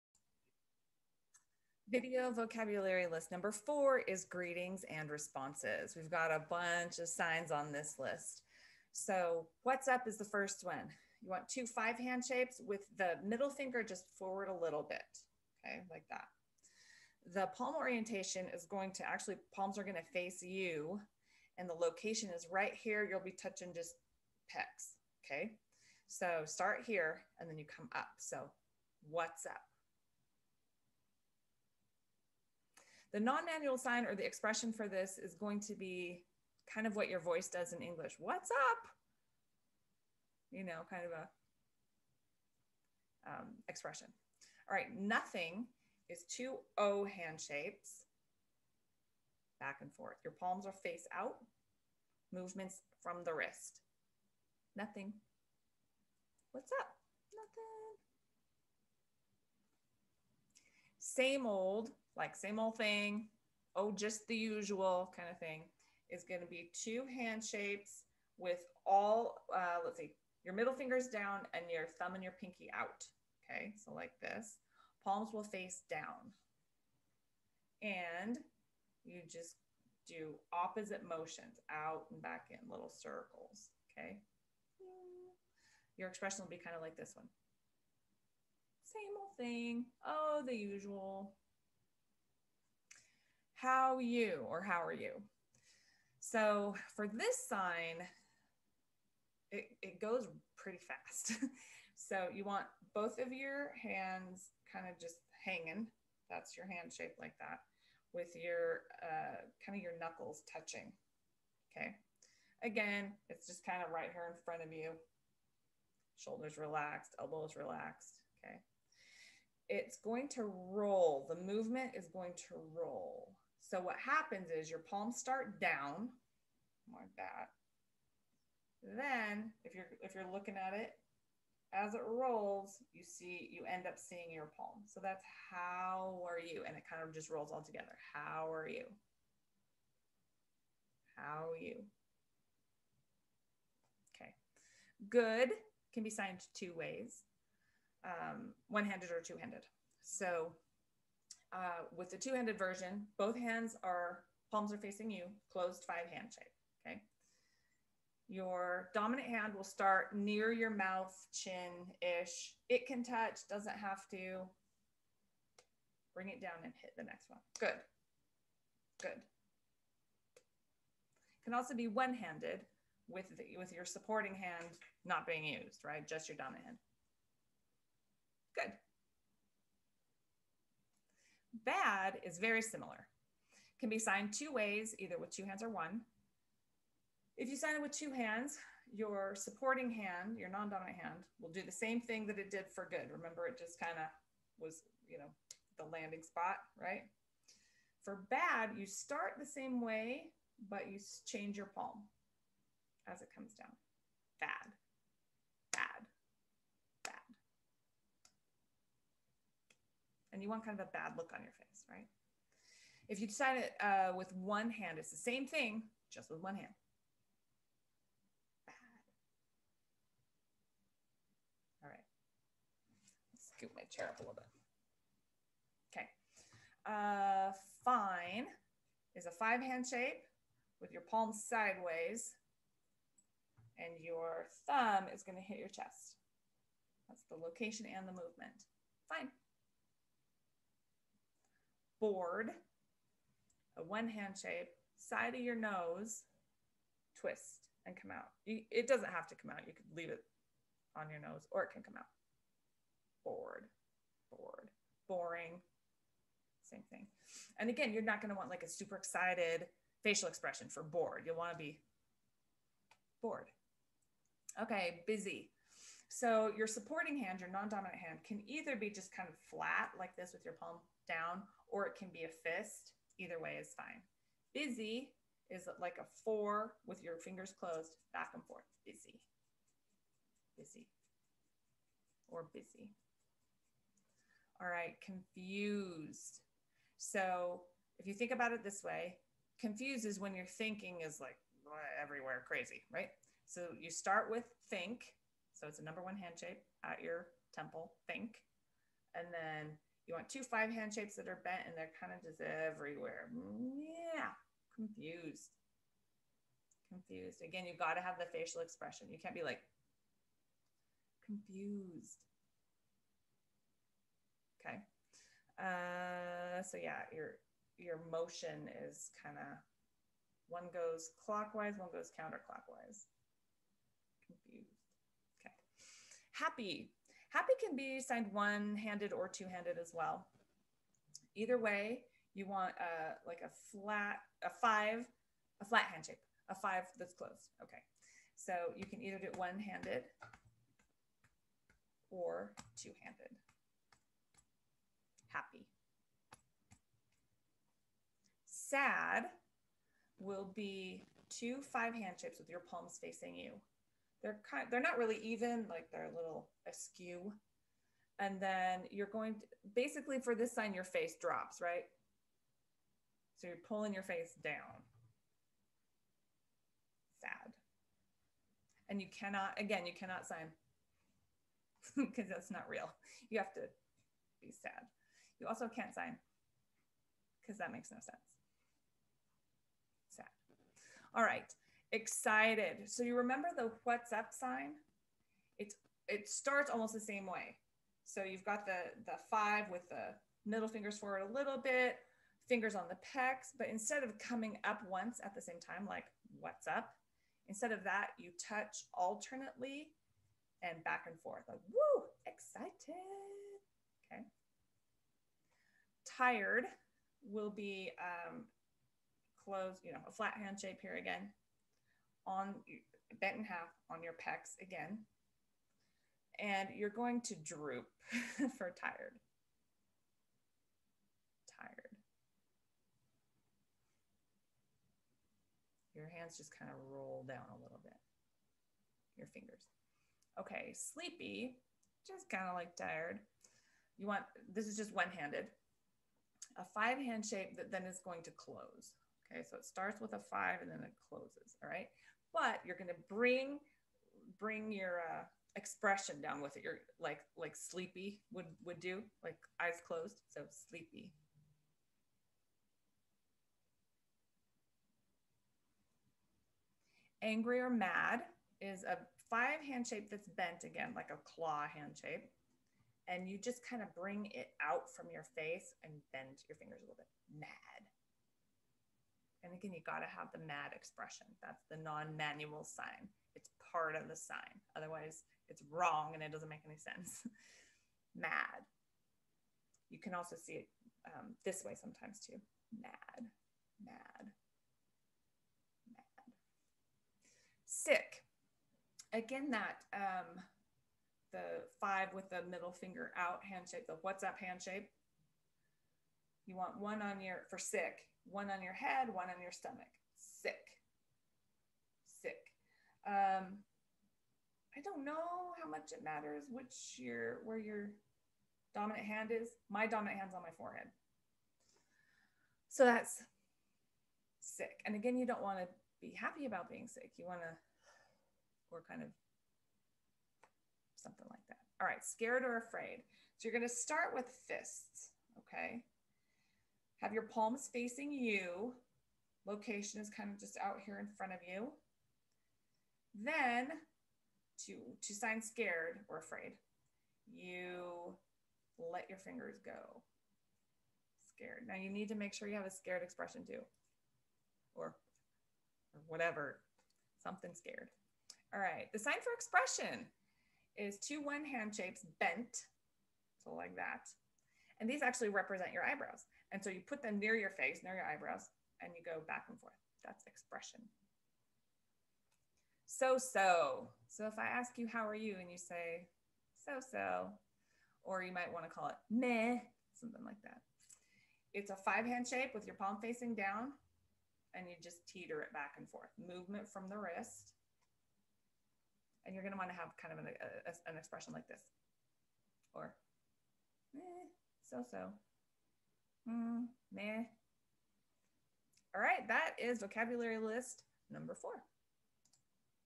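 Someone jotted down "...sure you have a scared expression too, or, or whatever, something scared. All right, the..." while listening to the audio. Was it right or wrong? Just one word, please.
right.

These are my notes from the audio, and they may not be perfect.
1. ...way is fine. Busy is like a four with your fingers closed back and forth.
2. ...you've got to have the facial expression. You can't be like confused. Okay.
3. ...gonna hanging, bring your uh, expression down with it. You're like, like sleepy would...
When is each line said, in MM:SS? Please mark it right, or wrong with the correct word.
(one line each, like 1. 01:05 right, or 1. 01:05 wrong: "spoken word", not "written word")
1. 04:33 right
2. 05:07 right
3. 07:22 wrong: "bring", not "hanging".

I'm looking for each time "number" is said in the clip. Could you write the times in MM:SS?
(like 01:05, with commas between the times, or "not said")
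00:03, 04:55, 09:51.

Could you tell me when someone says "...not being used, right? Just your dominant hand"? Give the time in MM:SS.
02:55.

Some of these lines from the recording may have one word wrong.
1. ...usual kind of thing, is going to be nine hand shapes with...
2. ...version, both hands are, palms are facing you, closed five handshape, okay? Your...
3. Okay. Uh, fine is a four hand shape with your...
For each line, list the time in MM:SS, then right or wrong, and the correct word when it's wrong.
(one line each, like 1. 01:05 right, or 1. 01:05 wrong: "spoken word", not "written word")
1. 01:04 wrong: "two", not "nine"
2. 02:32 right
3. 03:45 wrong: "five", not "four".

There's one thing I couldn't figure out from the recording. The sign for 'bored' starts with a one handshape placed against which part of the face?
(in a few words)
side of your nose.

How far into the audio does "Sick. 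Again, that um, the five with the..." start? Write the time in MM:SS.
08:07.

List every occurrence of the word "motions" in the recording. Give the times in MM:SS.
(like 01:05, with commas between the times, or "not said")
01:21, 05:18.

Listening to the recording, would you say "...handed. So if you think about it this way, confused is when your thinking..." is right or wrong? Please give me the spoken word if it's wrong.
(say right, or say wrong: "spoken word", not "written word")
wrong: "confused", not "handed".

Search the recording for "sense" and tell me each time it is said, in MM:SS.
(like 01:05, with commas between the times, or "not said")
06:17, 07:56.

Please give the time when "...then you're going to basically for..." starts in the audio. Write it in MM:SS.
05:58.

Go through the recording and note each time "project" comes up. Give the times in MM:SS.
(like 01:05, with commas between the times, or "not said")
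not said.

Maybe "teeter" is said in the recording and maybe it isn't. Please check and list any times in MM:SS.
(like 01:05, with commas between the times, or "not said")
09:35.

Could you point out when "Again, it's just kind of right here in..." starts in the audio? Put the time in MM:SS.
01:52.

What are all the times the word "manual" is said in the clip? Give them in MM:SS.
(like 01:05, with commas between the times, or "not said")
00:33, 07:52.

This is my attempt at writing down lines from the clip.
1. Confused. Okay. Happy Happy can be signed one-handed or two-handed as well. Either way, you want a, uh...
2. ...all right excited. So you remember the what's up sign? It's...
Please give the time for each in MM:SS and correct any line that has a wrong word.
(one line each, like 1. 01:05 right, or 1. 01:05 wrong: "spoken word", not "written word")
1. 05:24 right
2. 06:21 right.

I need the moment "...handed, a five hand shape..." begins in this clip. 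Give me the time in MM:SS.
07:15.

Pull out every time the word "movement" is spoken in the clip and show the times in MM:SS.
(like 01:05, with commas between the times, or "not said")
00:52, 02:01, 03:58, 09:36.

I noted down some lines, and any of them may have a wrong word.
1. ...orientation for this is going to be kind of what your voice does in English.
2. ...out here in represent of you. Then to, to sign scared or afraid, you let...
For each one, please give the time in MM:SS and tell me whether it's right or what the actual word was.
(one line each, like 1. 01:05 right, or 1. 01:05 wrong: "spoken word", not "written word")
1. 00:34 wrong: "expression", not "orientation"
2. 08:50 wrong: "front", not "represent".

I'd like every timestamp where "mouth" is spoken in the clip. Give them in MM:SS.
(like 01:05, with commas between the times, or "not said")
02:40.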